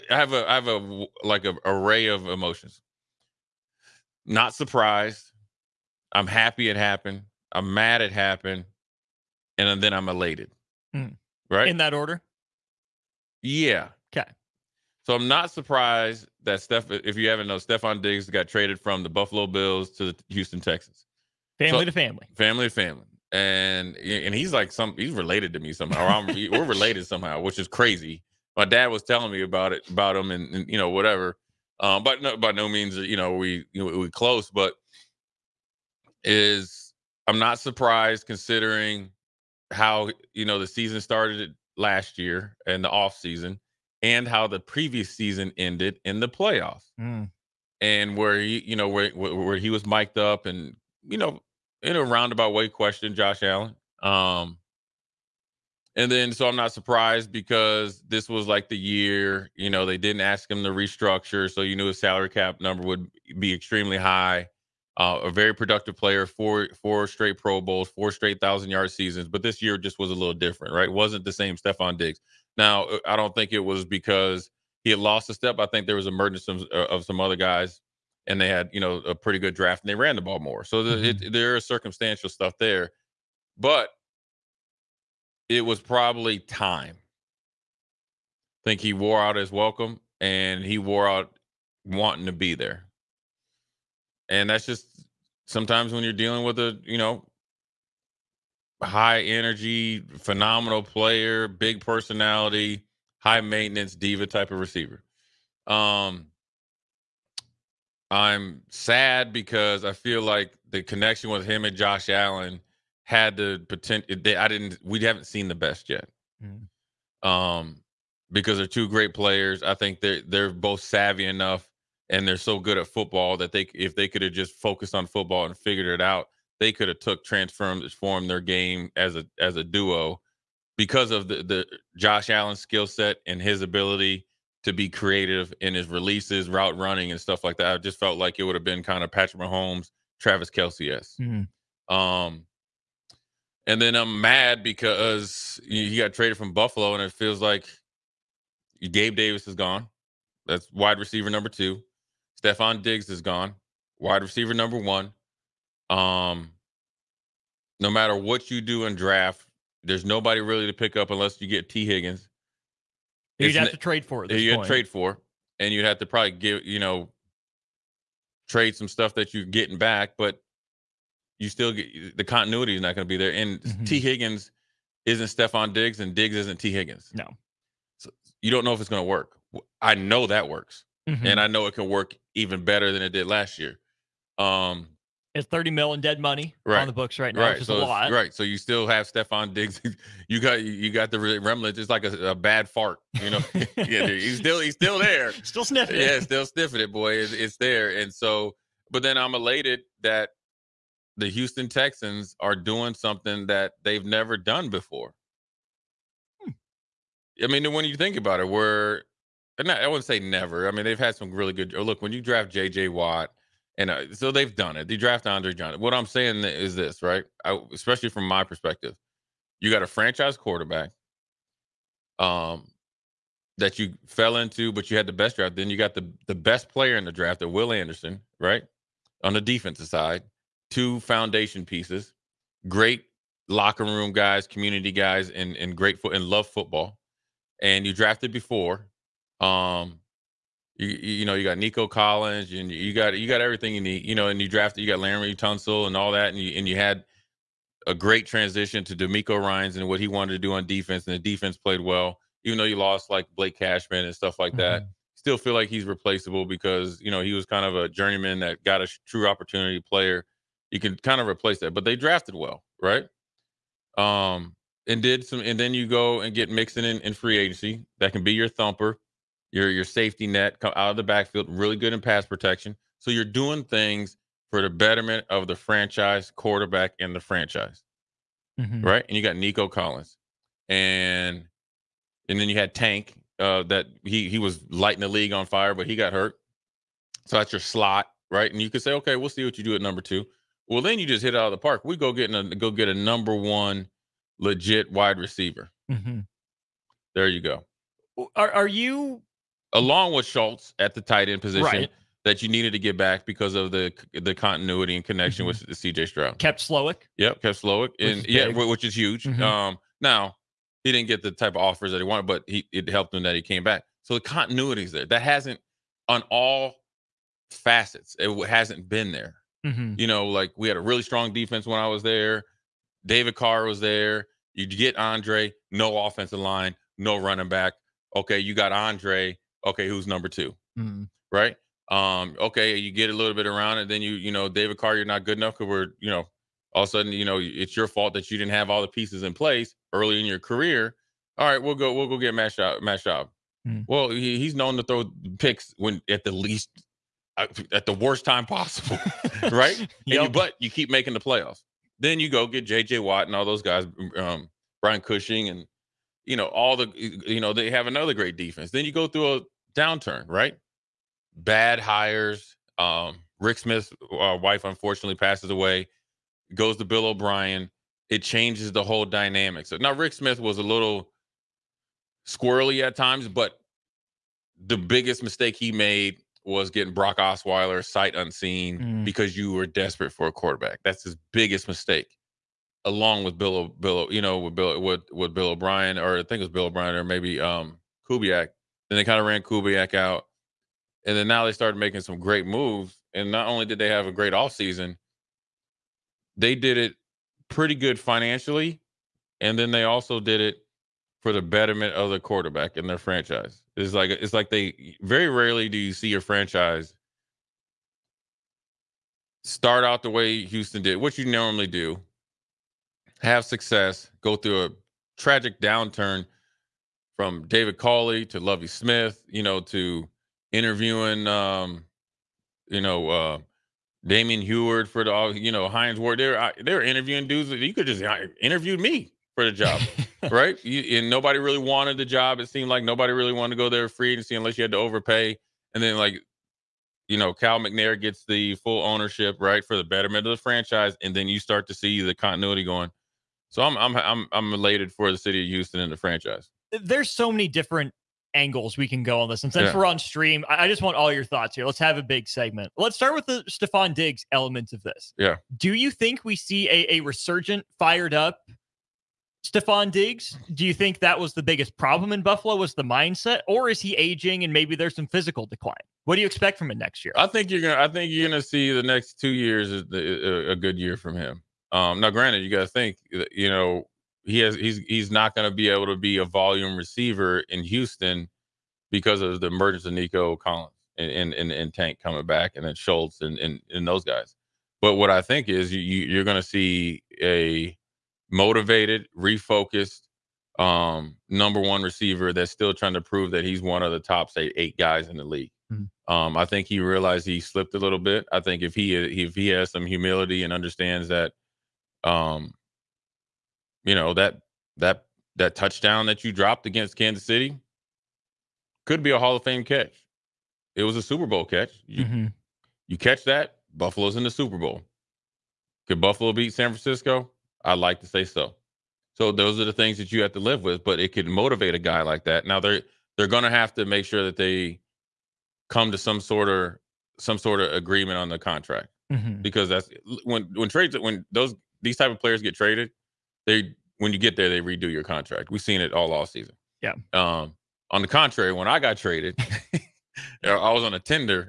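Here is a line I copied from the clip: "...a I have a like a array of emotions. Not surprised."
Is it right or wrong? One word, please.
right.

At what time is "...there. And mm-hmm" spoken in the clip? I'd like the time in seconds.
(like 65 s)
173 s.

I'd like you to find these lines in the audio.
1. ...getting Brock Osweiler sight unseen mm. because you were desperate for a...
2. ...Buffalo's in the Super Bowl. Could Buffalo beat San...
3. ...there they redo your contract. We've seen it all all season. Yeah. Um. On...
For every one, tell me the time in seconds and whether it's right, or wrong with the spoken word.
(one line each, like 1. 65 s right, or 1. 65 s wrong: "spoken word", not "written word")
1. 376 s right
2. 513 s right
3. 534 s right.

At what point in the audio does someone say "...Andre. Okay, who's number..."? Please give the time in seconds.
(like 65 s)
328 s.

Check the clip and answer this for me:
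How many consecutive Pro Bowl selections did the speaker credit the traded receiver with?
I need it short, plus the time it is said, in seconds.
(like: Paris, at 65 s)
4, at 66 s.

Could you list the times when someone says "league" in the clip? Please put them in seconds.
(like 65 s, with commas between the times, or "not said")
285 s, 495 s.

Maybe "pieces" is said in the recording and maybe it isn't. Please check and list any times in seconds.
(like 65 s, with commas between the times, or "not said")
231 s, 338 s.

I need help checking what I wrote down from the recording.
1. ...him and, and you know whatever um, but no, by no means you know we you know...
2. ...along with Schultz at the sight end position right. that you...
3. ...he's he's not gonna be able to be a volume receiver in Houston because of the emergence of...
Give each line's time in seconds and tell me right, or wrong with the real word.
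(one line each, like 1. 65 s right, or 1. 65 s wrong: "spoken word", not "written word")
1. 30 s right
2. 299 s wrong: "tight", not "sight"
3. 474 s right.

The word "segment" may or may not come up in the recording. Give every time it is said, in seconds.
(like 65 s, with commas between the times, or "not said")
452 s.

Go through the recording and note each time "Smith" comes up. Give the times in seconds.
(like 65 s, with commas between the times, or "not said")
363 s, 370 s, 418 s.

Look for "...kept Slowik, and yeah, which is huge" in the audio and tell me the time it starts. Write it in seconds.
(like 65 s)
307 s.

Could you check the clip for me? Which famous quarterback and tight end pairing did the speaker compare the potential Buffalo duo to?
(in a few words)
Patrick Mahomes, Travis Kelce.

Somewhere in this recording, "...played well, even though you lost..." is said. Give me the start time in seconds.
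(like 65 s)
251 s.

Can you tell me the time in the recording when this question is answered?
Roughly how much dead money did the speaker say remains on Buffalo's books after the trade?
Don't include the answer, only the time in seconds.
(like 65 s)
185 s.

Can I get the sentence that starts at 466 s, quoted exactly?
What do you expect from him next year?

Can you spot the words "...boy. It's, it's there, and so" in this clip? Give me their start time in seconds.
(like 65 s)
196 s.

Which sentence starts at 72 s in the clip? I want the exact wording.
Now, uh, I don't think it was because he had lost a step.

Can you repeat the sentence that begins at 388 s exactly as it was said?
Then they kind of ran Kubiak out, and then now they started making some great moves.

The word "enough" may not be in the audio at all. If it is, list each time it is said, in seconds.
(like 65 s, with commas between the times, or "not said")
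121 s, 335 s.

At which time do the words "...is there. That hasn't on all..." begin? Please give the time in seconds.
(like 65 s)
314 s.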